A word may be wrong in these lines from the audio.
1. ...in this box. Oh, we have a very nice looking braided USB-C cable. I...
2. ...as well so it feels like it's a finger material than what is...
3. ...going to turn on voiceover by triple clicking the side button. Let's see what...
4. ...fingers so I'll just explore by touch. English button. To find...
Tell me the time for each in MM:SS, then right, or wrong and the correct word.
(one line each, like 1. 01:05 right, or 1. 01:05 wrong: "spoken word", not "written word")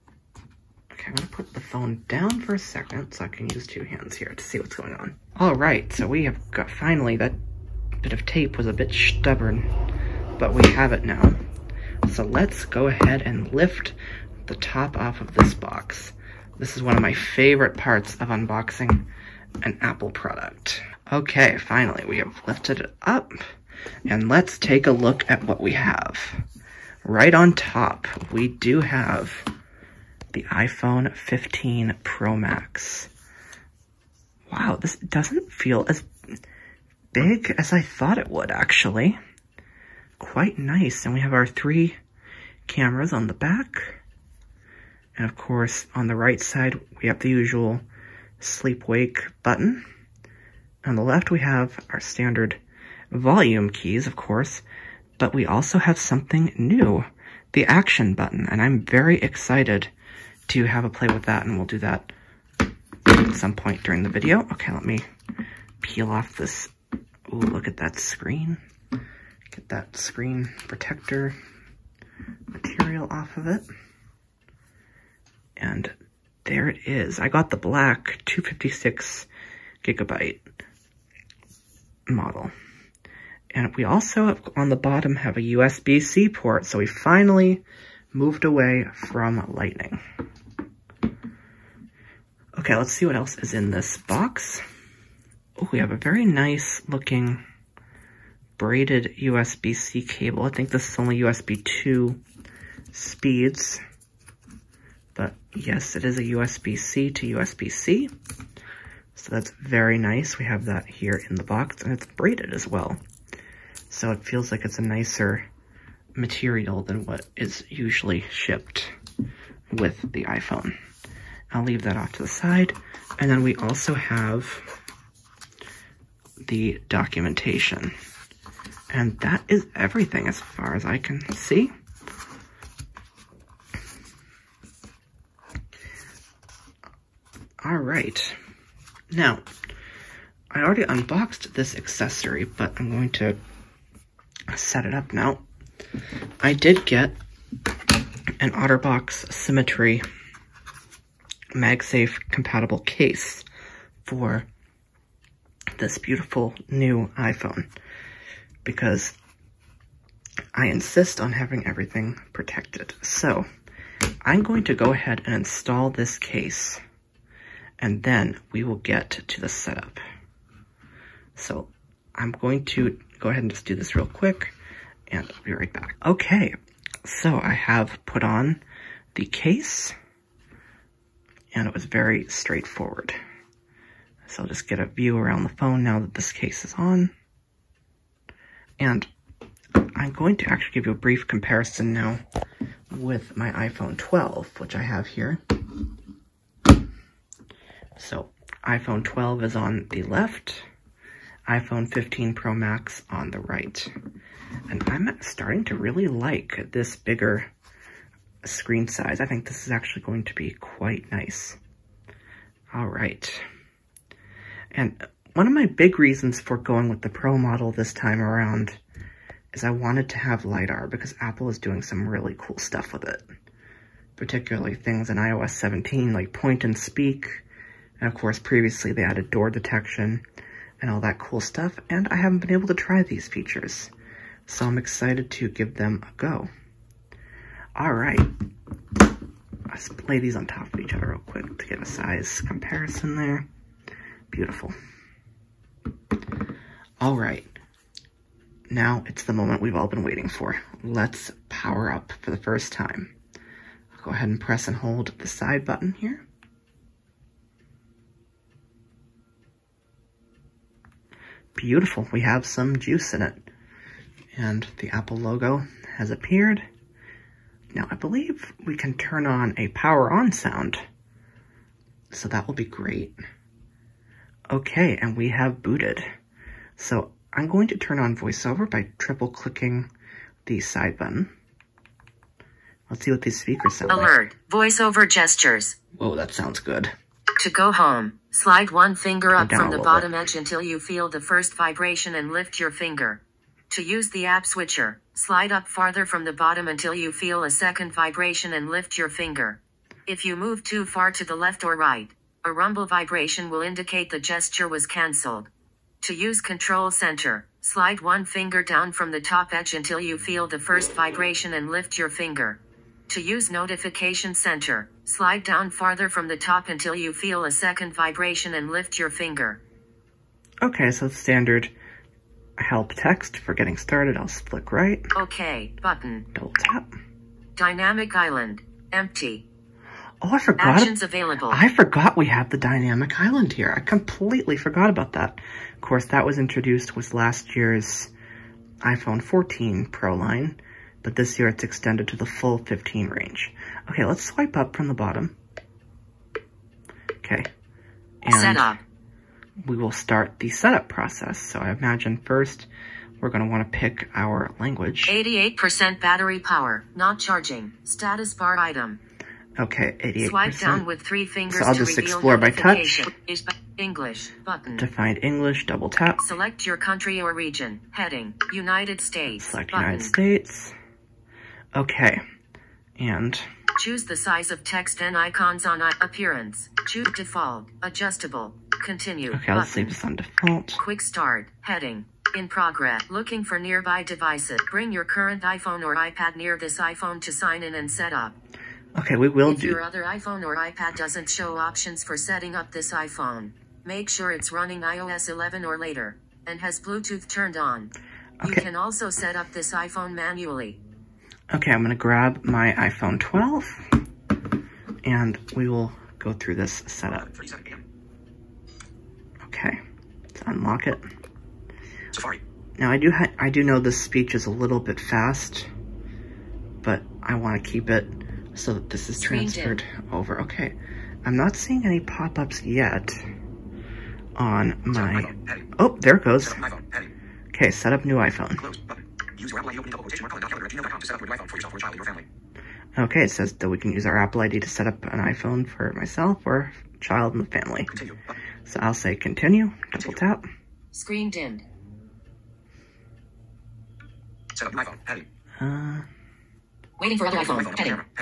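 1. 01:33 right
2. 01:52 wrong: "nicer", not "finger"
3. 04:37 right
4. 06:01 right.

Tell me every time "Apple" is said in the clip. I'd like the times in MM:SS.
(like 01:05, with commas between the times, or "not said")
00:19, 03:41, 04:24, 07:09, 07:14.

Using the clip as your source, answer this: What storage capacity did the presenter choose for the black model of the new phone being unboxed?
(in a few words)
256 gigabytes.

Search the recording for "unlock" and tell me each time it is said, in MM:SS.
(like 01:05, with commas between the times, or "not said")
06:50.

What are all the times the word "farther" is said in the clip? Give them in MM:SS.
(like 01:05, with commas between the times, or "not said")
04:55, 05:15.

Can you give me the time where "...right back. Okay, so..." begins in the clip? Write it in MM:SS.
02:55.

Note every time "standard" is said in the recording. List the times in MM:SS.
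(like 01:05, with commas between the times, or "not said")
00:51, 05:21.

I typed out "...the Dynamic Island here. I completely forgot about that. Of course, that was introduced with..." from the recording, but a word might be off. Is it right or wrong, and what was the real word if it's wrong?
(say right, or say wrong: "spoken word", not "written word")
right.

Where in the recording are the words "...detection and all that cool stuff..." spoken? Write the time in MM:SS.
03:49.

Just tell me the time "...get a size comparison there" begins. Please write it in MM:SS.
04:01.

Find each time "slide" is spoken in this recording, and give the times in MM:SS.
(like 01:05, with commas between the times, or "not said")
04:48, 04:55, 05:07, 05:15.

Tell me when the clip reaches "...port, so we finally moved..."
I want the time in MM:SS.
01:26.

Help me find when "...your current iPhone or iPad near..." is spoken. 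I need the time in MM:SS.
06:24.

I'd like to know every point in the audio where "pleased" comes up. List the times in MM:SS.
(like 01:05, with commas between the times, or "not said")
not said.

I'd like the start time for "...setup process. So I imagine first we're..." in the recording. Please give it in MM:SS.
05:50.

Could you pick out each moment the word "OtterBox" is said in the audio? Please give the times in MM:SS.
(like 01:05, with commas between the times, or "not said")
02:28.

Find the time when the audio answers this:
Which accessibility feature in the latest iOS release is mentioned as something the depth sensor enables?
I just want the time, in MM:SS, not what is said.
03:46.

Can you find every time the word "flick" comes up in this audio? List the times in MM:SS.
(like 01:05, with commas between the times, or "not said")
05:24.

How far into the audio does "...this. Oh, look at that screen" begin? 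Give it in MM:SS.
01:06.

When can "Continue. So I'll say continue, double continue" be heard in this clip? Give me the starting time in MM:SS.
07:17.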